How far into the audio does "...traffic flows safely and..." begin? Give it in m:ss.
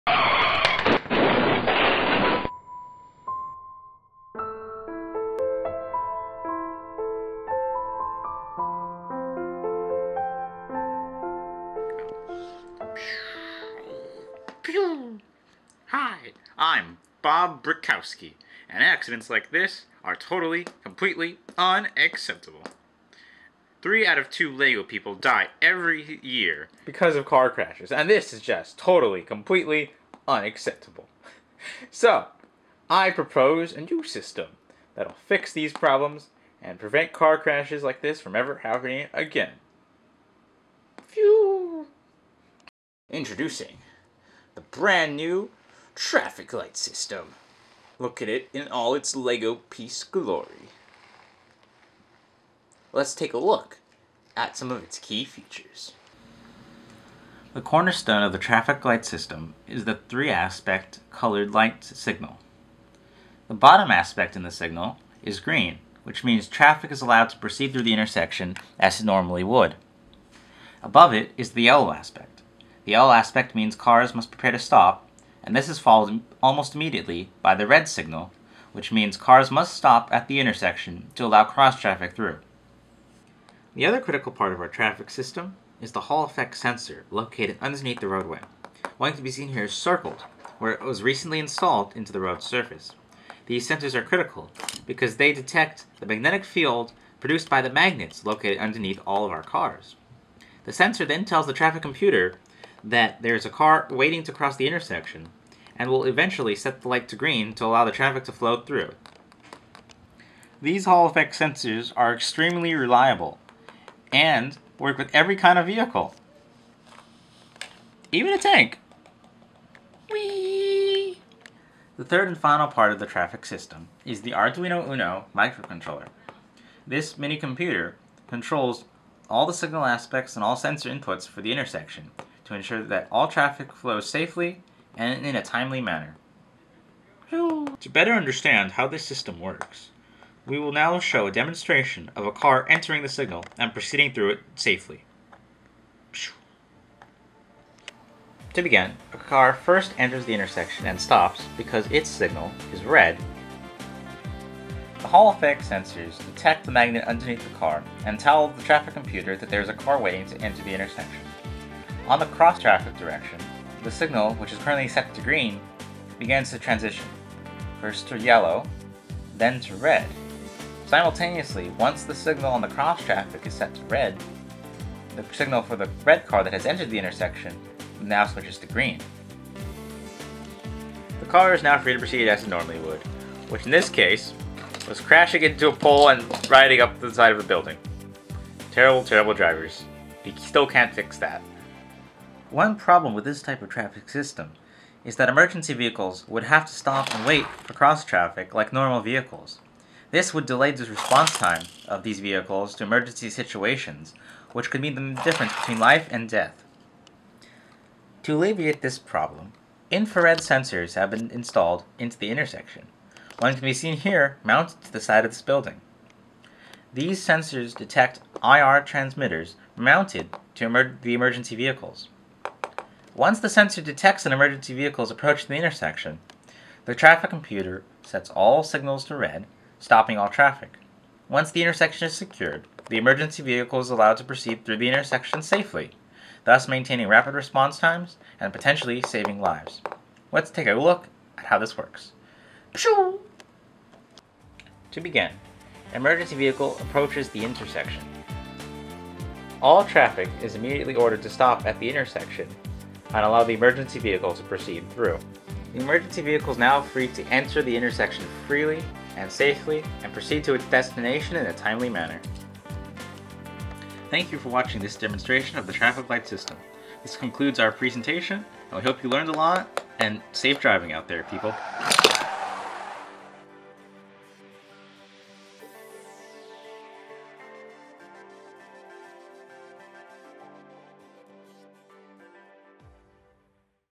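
2:13.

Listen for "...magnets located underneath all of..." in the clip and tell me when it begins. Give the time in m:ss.
1:37.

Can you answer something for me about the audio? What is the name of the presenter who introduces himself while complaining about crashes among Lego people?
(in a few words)
Bob Brickowski.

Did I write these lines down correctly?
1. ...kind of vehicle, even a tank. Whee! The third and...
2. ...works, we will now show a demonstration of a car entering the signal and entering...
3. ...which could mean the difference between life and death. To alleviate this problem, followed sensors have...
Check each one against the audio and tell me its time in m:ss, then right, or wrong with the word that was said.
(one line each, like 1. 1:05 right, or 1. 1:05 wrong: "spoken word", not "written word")
1. 1:55 right
2. 2:19 wrong: "proceeding", not "entering"
3. 3:24 wrong: "infrared", not "followed".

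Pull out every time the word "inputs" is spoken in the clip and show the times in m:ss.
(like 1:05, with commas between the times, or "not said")
2:10.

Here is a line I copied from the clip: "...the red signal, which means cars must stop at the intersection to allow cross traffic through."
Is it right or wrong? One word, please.
right.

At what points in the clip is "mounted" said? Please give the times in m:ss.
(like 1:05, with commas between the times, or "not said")
3:34, 3:39.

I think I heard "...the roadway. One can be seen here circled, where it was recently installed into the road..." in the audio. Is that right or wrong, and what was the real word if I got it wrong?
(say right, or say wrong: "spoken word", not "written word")
right.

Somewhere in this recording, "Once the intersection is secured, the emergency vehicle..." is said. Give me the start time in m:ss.
3:51.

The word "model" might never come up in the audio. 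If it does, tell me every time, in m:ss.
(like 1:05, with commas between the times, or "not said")
not said.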